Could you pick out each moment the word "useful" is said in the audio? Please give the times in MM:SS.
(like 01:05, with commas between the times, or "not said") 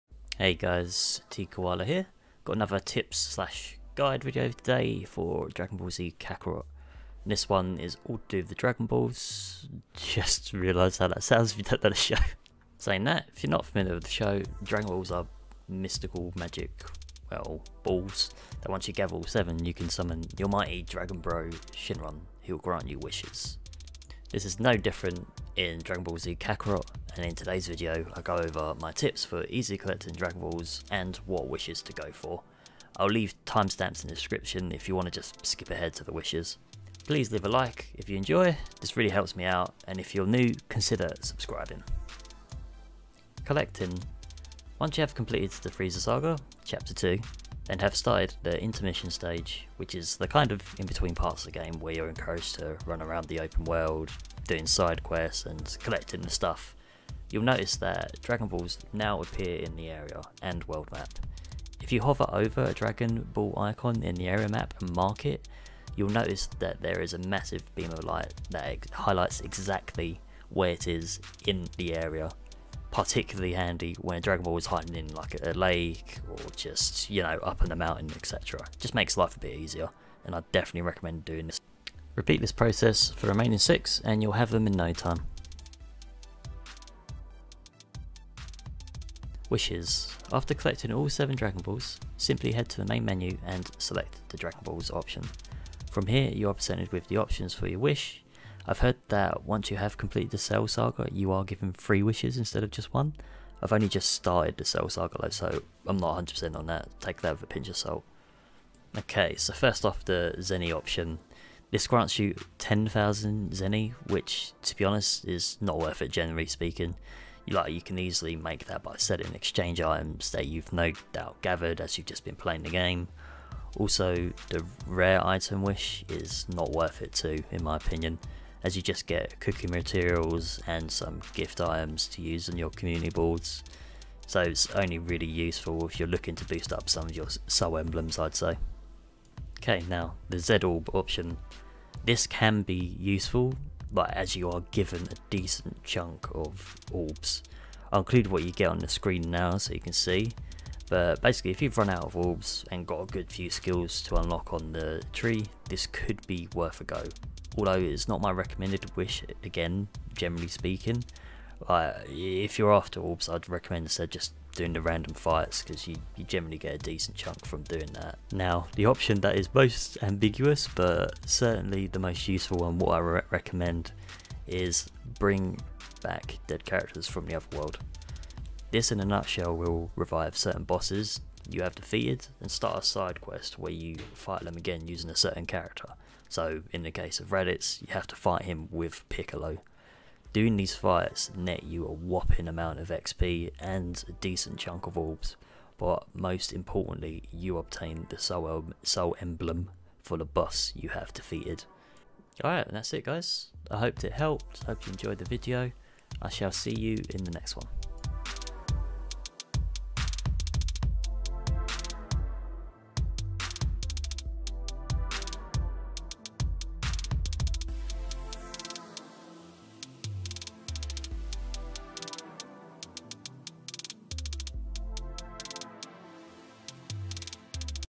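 02:15, 02:22, 02:52.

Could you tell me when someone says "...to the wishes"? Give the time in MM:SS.
00:35.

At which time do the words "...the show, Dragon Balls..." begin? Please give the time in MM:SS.
00:14.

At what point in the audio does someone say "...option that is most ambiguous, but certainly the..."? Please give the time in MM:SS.
02:48.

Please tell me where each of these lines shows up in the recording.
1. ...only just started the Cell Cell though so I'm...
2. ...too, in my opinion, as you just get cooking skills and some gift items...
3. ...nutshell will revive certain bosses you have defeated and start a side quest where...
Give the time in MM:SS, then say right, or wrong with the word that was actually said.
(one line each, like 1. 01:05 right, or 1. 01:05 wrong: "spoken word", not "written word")
1. 01:43 wrong: "Saga", not "Cell"
2. 02:07 wrong: "materials", not "skills"
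3. 02:59 right.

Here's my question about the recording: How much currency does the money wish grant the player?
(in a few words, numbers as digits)
10,000 Zeni.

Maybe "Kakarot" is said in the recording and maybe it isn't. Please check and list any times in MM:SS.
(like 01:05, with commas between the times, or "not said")
00:06, 00:26.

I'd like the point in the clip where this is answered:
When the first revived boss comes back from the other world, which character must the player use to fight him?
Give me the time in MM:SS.
03:09.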